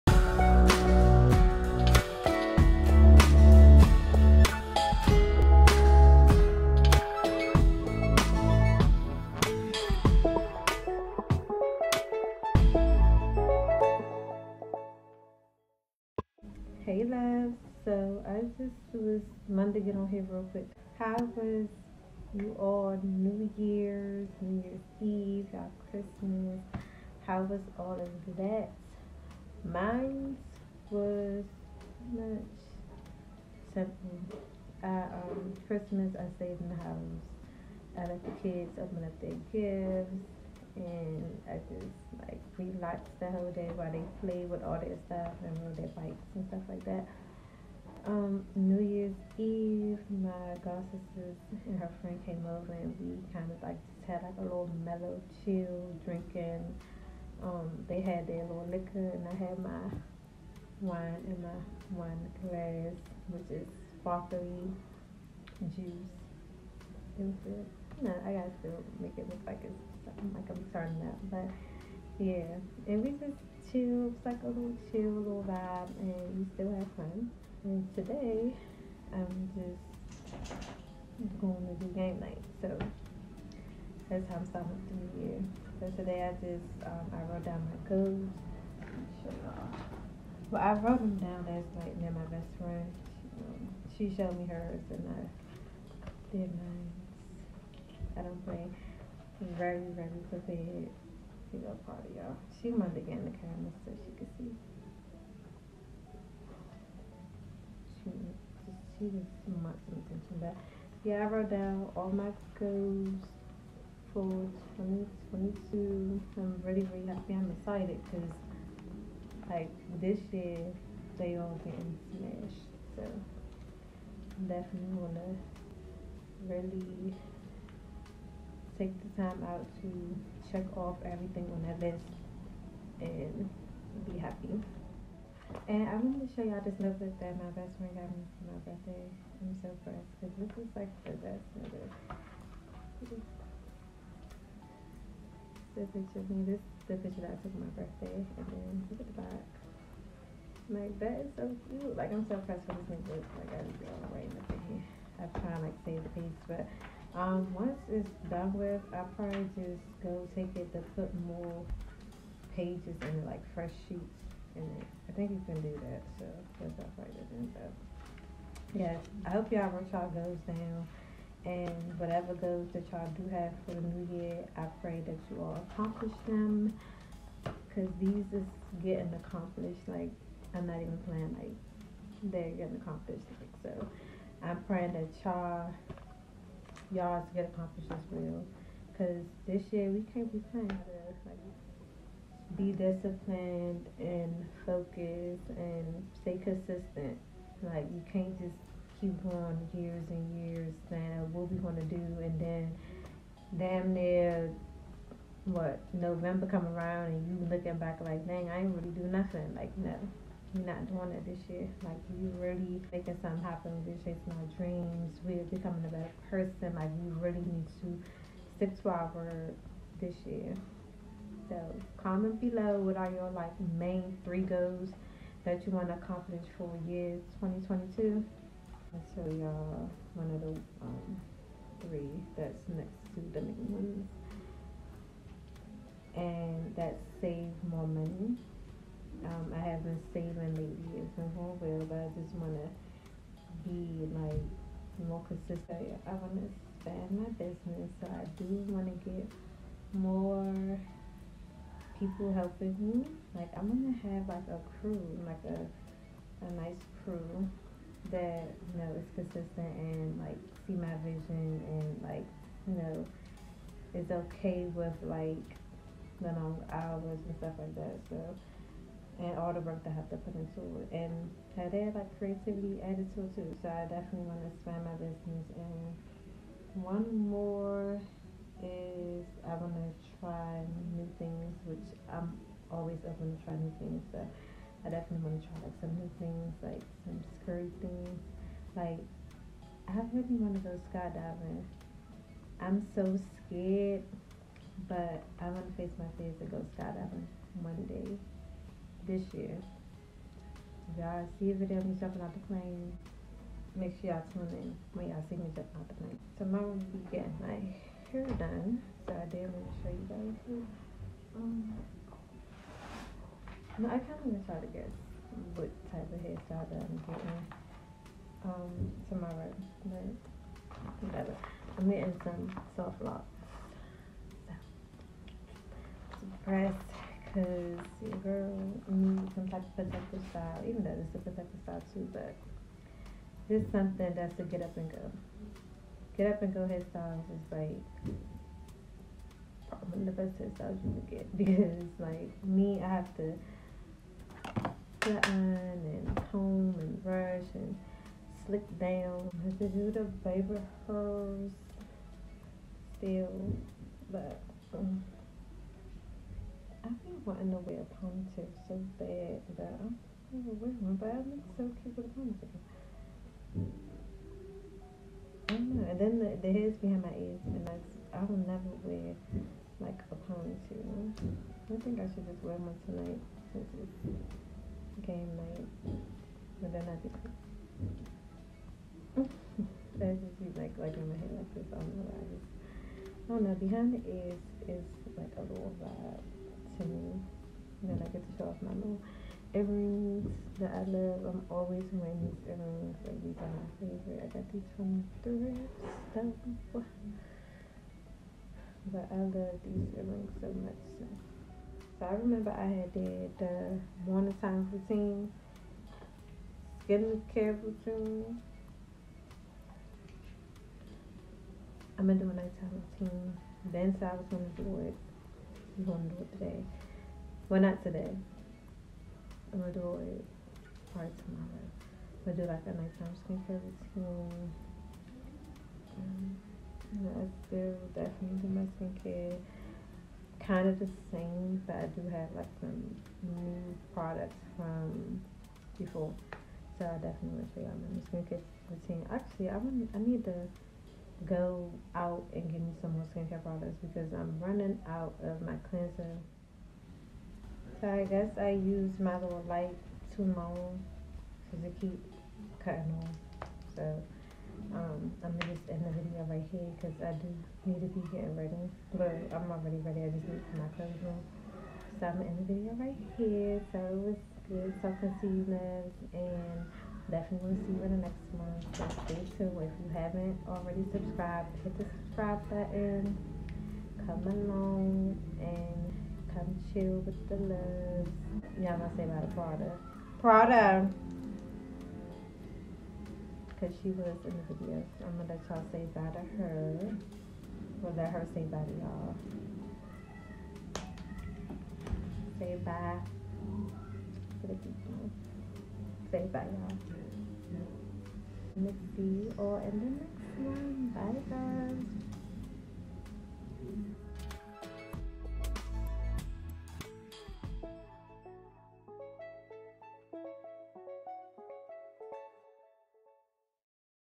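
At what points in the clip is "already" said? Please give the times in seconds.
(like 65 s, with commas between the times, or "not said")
459 s, 470 s.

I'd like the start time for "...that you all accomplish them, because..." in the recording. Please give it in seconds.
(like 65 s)
175 s.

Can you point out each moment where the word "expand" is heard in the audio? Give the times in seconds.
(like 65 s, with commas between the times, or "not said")
246 s, 274 s.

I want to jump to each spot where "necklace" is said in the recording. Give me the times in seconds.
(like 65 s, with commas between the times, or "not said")
136 s, 141 s, 152 s.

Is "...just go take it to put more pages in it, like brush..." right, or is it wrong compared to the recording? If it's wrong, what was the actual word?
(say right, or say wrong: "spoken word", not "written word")
wrong: "fresh", not "brush".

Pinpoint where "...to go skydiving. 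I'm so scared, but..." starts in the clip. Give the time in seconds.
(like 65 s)
290 s.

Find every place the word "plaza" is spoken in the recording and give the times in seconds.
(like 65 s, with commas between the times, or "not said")
not said.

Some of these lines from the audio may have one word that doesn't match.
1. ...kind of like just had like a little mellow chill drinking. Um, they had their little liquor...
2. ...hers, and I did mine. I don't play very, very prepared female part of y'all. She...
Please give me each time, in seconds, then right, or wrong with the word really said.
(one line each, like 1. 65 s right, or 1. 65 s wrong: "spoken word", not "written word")
1. 53 s right
2. 94 s right.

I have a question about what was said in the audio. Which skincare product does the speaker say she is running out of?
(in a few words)
cleanser.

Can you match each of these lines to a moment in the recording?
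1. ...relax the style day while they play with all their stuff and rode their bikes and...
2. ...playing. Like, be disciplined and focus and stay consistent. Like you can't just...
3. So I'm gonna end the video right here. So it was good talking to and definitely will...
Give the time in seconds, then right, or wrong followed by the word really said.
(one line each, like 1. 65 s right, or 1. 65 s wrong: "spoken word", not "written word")
1. 42 s wrong: "whole", not "style"
2. 190 s right
3. 461 s right.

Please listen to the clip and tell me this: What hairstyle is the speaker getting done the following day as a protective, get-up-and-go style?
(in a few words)
soft locks.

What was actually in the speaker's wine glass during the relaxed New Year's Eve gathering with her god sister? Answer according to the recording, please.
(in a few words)
sparkly juice.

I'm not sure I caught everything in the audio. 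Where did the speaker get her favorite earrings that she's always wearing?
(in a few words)
thrift store.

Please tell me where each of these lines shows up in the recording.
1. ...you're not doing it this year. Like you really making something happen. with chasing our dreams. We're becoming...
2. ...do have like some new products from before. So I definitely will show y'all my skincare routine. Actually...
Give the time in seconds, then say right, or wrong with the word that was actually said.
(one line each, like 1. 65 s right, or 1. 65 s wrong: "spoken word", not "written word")
1. 210 s right
2. 431 s right.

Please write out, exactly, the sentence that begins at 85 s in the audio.
So today I just, um, I wrote down my goals.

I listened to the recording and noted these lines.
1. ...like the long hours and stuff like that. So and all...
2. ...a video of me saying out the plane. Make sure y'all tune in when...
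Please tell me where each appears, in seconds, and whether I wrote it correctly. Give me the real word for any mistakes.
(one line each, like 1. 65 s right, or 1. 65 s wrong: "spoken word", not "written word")
1. 265 s right
2. 301 s wrong: "jumping", not "saying".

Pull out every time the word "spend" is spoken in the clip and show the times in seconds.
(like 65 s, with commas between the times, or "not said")
not said.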